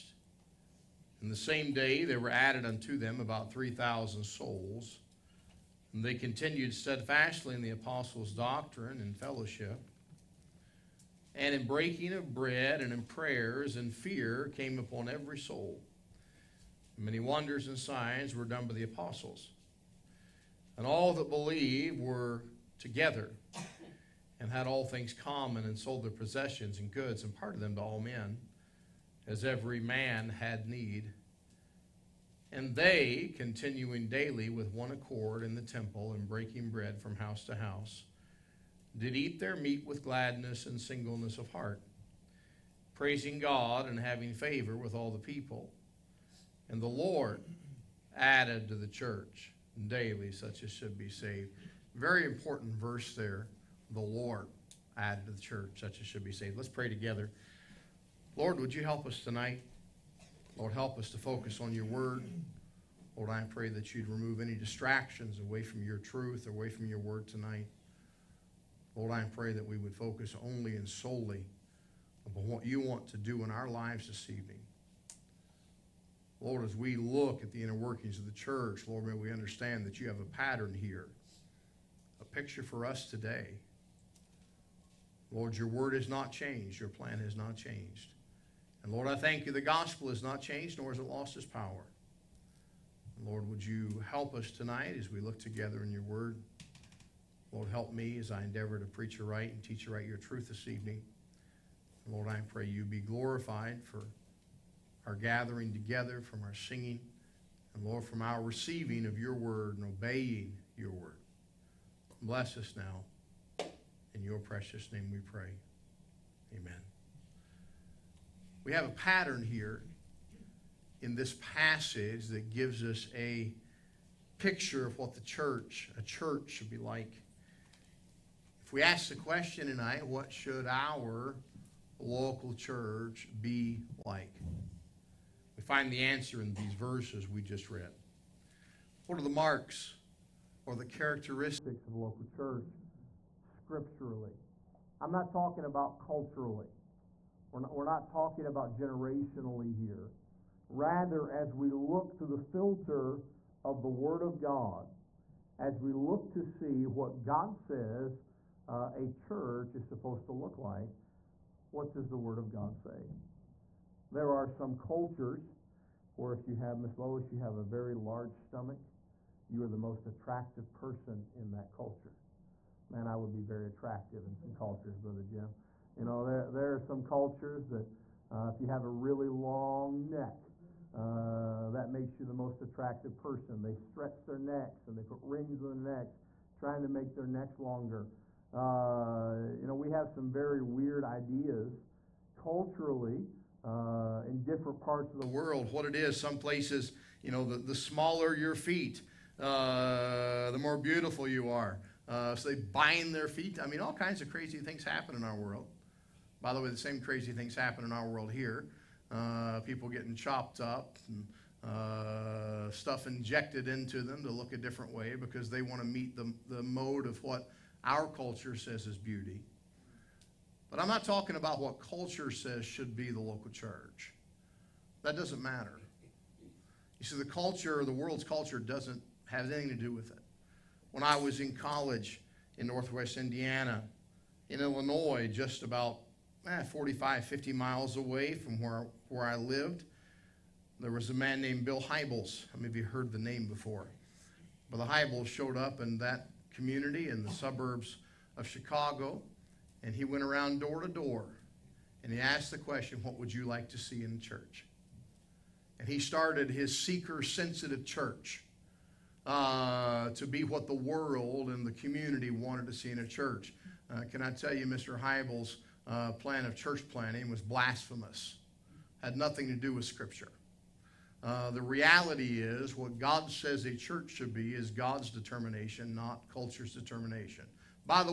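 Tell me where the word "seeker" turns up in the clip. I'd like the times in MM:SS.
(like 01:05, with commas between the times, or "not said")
04:16.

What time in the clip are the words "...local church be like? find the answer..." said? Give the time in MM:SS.
02:11.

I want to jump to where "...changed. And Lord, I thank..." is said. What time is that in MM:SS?
01:27.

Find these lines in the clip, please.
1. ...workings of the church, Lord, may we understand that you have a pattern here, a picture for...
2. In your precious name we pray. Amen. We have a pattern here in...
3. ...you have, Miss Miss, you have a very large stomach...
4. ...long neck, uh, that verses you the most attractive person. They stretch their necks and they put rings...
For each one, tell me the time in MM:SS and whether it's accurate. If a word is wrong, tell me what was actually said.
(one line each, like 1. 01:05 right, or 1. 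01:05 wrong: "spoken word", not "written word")
1. 01:17 right
2. 01:54 right
3. 02:46 wrong: "Lois", not "Miss"
4. 02:59 wrong: "makes", not "verses".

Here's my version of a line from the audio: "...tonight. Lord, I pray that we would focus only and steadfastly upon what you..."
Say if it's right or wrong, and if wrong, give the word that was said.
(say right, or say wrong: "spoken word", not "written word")
wrong: "solely", not "steadfastly".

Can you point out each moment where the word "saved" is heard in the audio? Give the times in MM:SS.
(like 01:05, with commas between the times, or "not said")
00:51, 00:56.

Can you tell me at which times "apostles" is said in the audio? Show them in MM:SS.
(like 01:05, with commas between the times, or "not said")
00:07, 00:18.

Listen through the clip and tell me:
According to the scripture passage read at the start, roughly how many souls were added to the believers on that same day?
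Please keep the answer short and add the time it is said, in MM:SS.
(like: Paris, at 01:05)
3,000, at 00:03.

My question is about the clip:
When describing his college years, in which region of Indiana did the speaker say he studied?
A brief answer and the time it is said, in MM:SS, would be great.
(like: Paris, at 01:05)
Northwest Indiana, at 03:52.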